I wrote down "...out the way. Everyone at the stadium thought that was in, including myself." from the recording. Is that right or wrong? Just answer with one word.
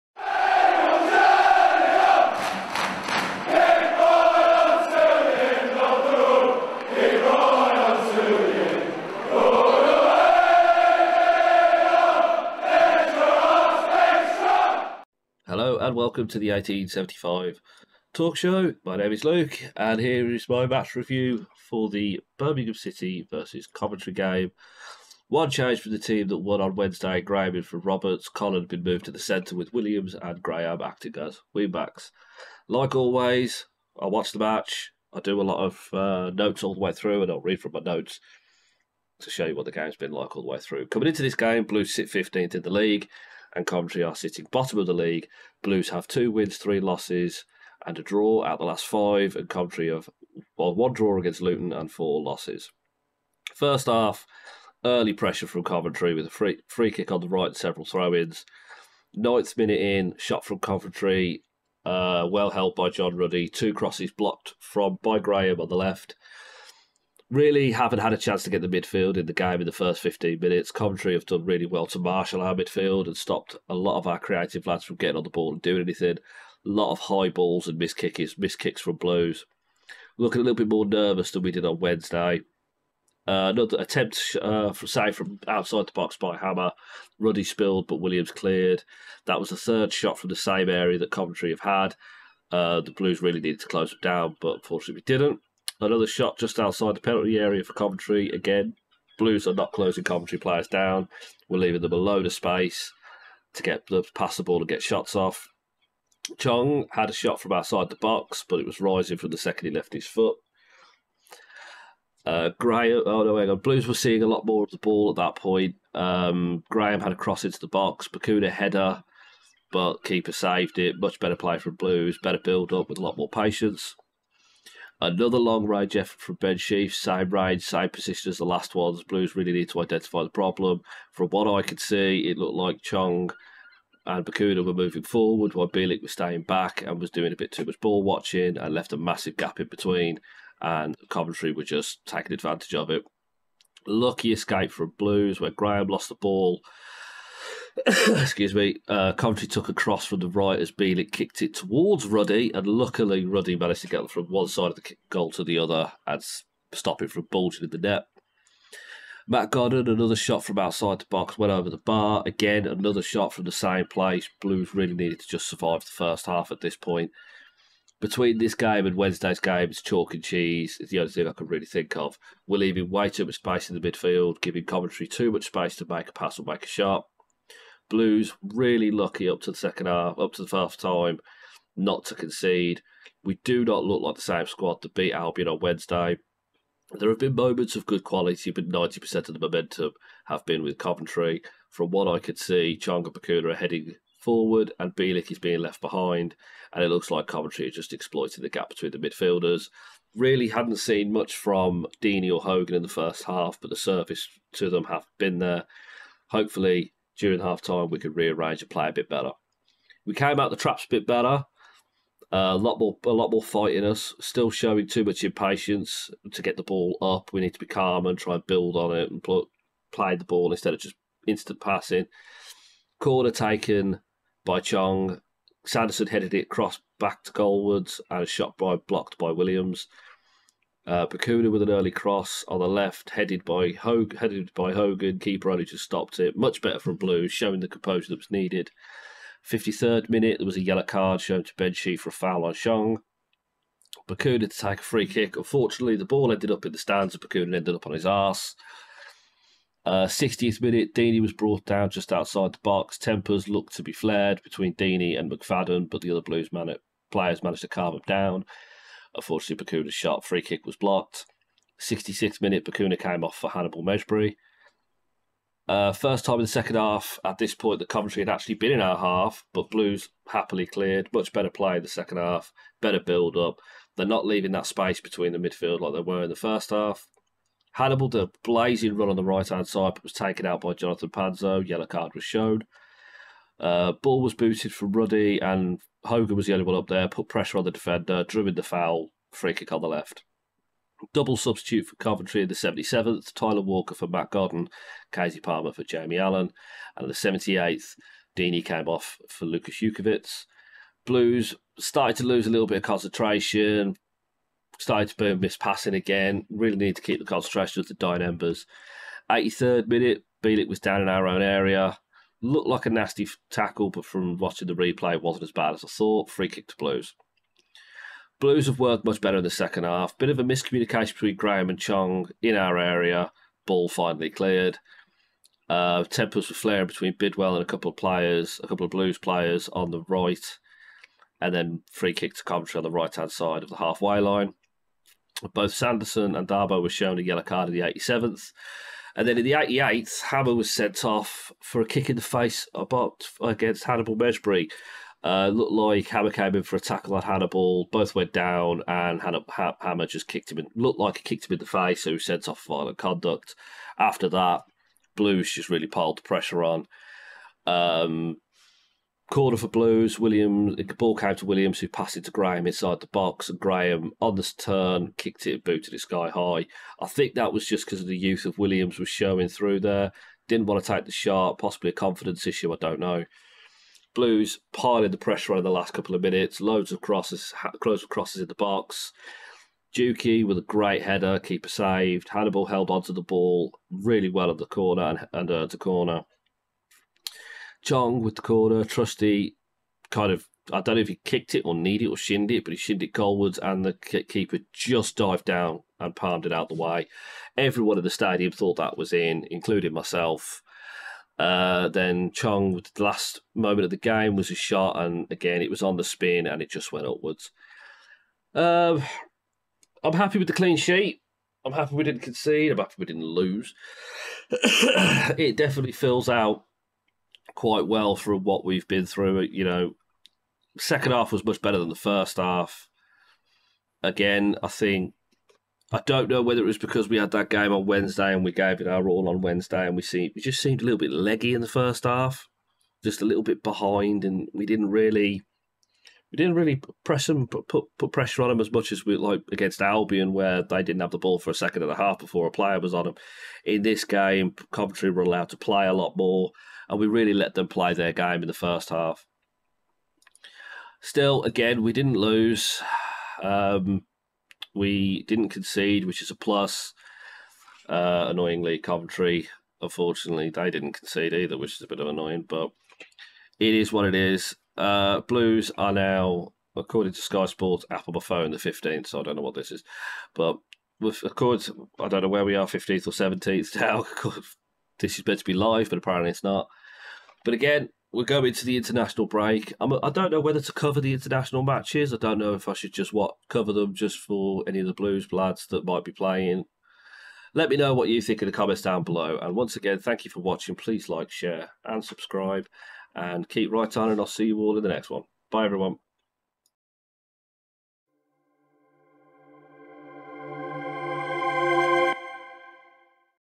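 right.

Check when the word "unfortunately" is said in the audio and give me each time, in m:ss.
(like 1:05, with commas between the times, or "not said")
1:34, 4:05, 4:19, 7:39.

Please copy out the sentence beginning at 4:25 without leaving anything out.
Uh, first time in the second half, at this point, the Coventry had actually been in our half, but Blues happily cleared.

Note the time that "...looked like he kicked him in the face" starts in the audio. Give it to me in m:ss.
5:50.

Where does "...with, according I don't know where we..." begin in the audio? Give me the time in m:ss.
7:50.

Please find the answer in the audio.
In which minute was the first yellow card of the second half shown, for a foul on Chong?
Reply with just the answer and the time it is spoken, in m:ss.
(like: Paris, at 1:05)
53rd, at 3:59.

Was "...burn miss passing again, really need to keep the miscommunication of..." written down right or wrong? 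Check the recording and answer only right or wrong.
wrong.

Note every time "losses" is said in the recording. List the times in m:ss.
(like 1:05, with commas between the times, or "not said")
0:46, 0:52.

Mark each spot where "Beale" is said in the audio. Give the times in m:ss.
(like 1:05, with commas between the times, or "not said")
2:30.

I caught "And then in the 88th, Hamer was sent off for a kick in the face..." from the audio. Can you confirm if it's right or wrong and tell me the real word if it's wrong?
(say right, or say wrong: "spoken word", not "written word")
right.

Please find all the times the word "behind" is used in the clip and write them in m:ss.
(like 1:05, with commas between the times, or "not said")
3:15, 7:13.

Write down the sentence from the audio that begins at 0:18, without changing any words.
My name is Luke, and here is my match review for the Birmingham City versus Coventry game.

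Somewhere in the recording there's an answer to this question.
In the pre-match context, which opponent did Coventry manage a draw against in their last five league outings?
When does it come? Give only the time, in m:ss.
0:51.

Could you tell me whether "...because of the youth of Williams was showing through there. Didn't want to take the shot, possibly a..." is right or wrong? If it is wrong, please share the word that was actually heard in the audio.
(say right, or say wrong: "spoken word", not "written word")
right.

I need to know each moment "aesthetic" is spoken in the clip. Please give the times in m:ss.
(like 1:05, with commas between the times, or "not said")
not said.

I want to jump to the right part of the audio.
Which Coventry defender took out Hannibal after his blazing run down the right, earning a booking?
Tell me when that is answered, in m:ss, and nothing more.
4:40.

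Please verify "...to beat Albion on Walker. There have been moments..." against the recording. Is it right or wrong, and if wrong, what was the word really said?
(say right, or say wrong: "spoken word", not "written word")
wrong: "Wednesday", not "Walker".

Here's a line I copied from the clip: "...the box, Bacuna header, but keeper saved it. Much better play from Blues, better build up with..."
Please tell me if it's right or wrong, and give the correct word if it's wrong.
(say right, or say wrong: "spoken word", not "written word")
right.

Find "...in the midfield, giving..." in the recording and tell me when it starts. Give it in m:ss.
2:53.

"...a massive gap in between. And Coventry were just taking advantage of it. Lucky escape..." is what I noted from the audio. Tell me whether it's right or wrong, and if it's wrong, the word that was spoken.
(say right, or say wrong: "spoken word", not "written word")
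right.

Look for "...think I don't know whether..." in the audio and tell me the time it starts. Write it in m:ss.
7:04.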